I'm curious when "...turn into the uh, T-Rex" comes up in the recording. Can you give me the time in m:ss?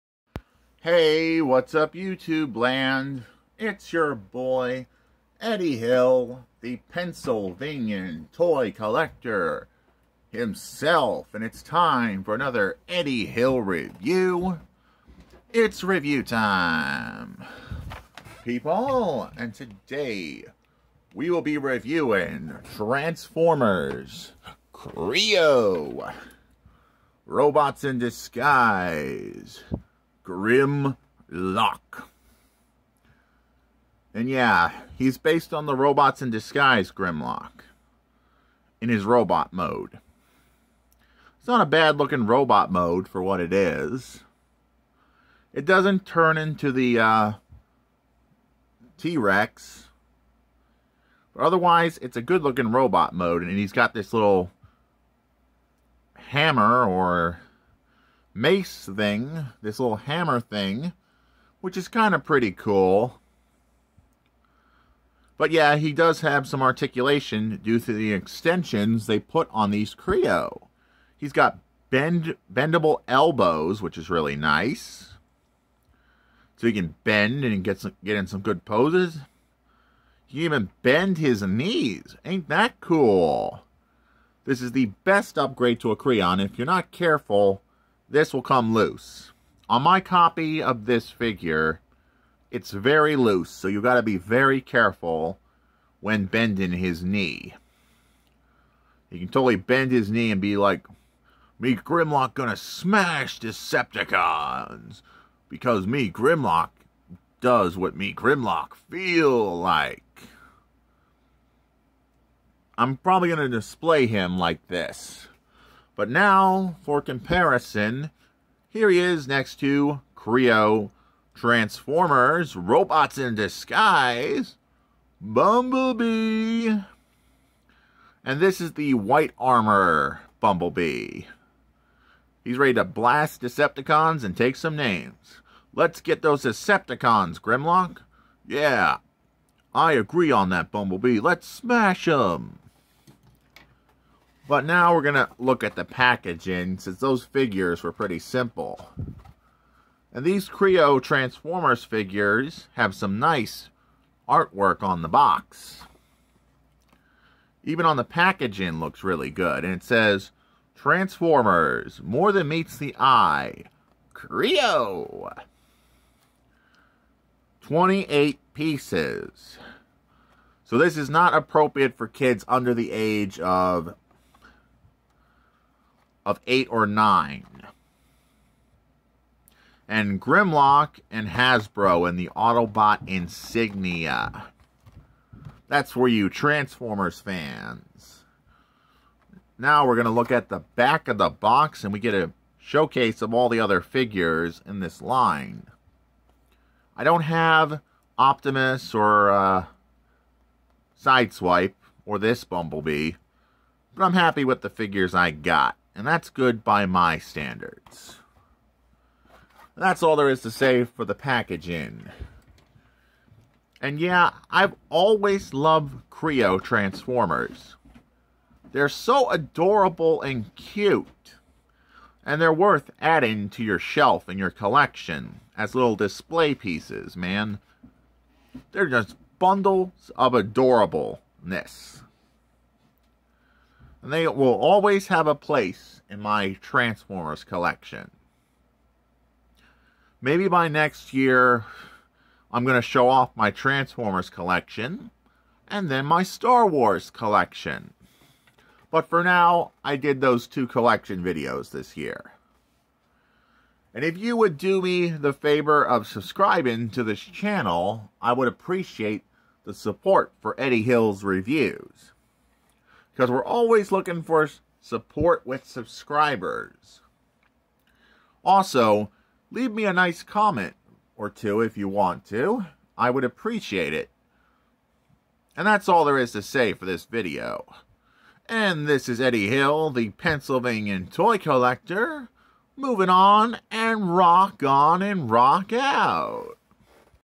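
0:46.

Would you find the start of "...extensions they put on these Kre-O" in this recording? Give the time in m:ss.
1:08.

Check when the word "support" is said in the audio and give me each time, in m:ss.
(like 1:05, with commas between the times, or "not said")
4:19, 4:24.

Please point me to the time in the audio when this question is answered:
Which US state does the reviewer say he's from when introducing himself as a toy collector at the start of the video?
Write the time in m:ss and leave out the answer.
0:06.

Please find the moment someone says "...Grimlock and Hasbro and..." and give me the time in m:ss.
3:00.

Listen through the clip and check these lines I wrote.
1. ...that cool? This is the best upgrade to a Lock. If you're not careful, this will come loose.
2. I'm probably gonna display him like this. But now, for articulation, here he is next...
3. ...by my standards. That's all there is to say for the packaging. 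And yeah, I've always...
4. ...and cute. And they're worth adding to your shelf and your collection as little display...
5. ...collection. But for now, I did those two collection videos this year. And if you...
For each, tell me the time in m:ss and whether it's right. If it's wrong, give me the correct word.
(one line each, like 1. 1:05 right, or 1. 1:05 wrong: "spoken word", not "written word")
1. 1:22 wrong: "Creon", not "Lock"
2. 1:52 wrong: "comparison", not "articulation"
3. 3:26 right
4. 3:40 right
5. 4:07 right.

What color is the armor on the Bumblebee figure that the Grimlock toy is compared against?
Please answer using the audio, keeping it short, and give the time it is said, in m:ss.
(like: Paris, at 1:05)
White, at 2:08.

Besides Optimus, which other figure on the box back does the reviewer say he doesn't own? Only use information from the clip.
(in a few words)
Sideswipe.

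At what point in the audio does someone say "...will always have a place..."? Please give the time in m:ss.
3:54.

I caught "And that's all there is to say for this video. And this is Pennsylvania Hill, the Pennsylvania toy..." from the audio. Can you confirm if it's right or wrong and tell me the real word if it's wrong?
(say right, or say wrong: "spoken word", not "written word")
wrong: "Eddie", not "Pennsylvania".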